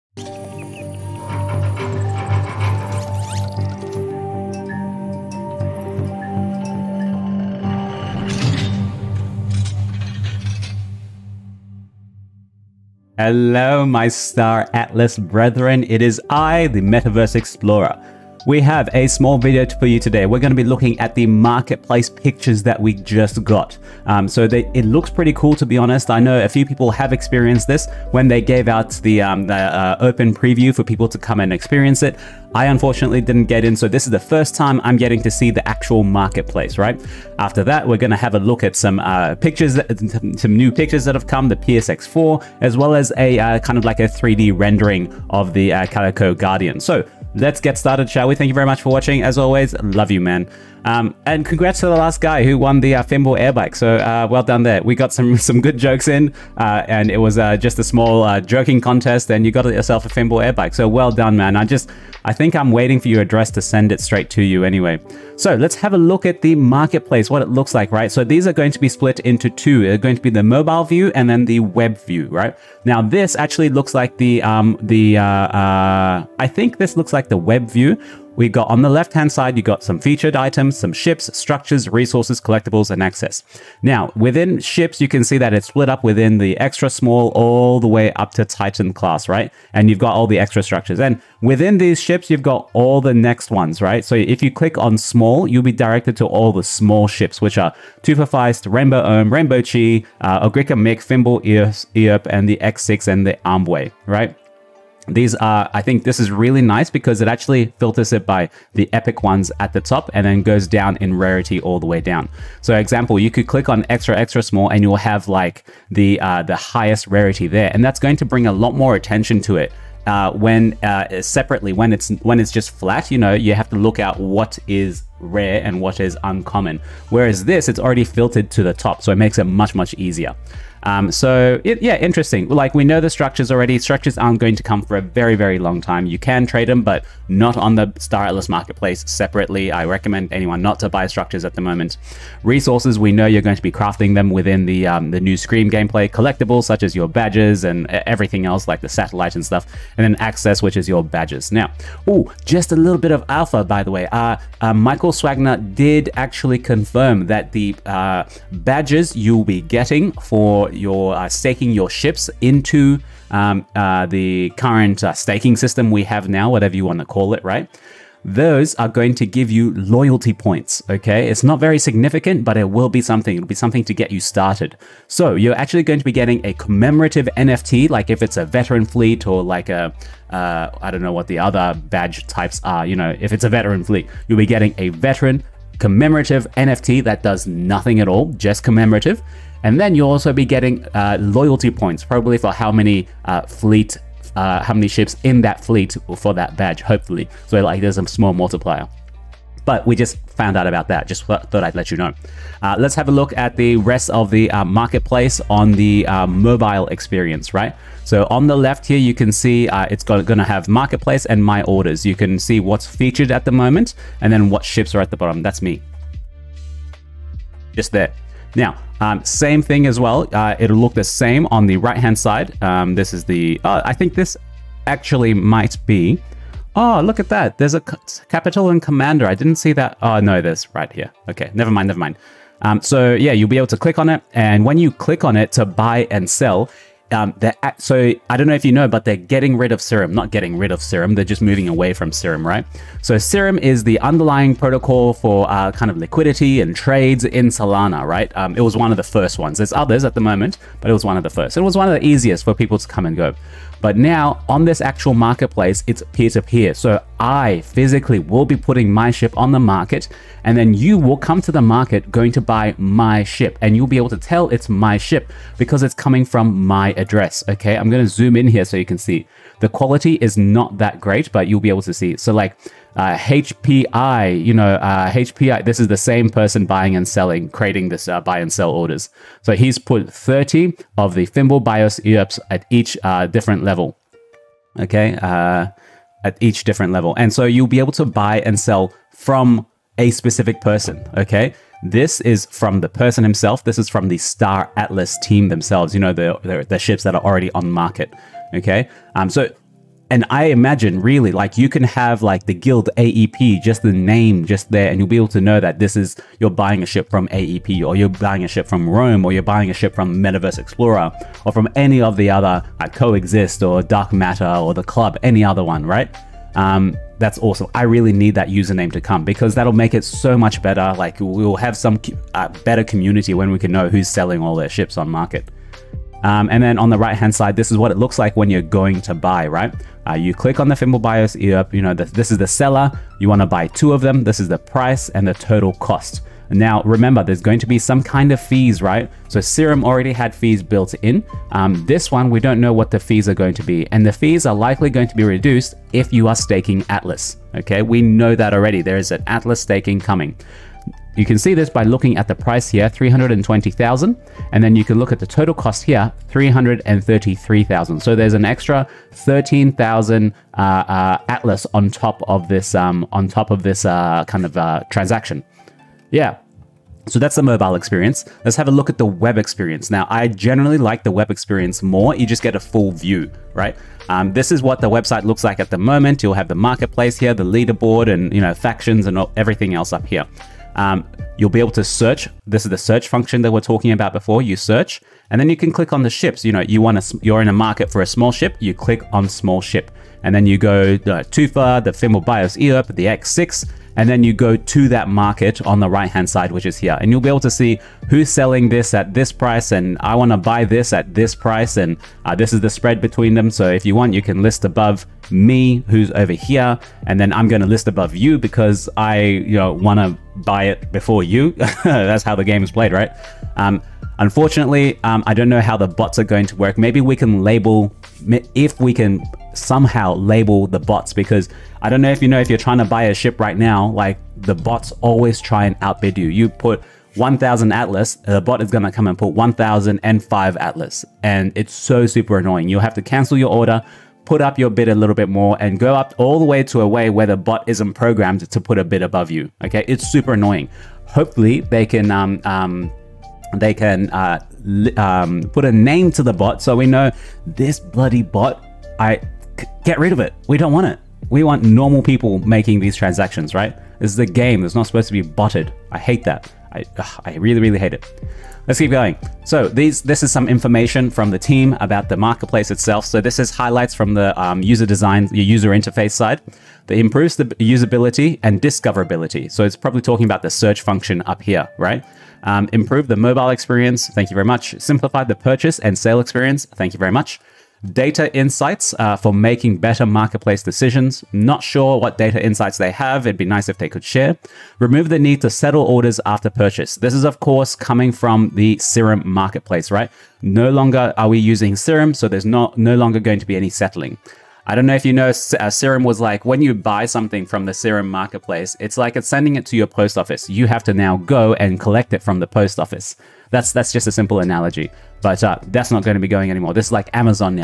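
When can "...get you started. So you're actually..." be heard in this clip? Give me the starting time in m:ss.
2:53.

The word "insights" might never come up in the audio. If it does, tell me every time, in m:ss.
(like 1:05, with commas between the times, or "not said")
7:58, 8:02.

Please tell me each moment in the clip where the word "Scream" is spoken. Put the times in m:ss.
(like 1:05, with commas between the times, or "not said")
2:25.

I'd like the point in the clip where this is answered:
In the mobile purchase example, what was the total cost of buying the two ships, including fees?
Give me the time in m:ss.
5:56.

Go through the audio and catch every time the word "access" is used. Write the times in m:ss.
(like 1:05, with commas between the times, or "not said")
1:23, 2:30.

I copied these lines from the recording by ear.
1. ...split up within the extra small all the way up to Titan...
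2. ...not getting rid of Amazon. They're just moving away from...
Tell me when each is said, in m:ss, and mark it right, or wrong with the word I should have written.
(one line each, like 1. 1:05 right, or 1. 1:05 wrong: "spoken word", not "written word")
1. 1:25 right
2. 4:00 wrong: "Serum", not "Amazon".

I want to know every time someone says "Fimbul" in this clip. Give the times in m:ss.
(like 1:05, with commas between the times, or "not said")
1:00, 1:41, 4:41, 5:30, 6:31.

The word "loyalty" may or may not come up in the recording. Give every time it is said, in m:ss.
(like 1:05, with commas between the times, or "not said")
2:49, 3:11.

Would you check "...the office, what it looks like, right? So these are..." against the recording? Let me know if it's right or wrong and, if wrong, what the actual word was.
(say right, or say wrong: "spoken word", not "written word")
wrong: "marketplace", not "office".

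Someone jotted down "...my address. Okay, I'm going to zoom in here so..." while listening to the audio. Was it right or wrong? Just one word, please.
right.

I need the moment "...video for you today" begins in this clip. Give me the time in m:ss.
0:19.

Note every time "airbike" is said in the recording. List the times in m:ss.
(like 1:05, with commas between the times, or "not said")
0:53, 1:00.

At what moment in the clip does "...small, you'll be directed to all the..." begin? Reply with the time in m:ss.
1:34.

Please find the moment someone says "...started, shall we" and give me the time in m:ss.
0:47.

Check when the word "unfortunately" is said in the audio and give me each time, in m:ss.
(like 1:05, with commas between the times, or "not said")
0:32, 6:54.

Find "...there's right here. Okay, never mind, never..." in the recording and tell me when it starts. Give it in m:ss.
3:50.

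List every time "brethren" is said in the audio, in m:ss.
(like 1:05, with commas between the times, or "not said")
0:15.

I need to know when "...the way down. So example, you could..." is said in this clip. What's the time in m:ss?
1:51.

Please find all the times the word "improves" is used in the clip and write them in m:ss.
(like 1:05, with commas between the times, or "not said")
7:46, 7:52.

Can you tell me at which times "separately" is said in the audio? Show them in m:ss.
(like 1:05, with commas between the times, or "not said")
2:01, 2:19.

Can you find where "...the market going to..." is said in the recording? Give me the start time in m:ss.
4:21.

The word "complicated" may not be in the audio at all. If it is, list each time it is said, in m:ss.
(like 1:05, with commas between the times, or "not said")
not said.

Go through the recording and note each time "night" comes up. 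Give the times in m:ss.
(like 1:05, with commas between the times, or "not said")
not said.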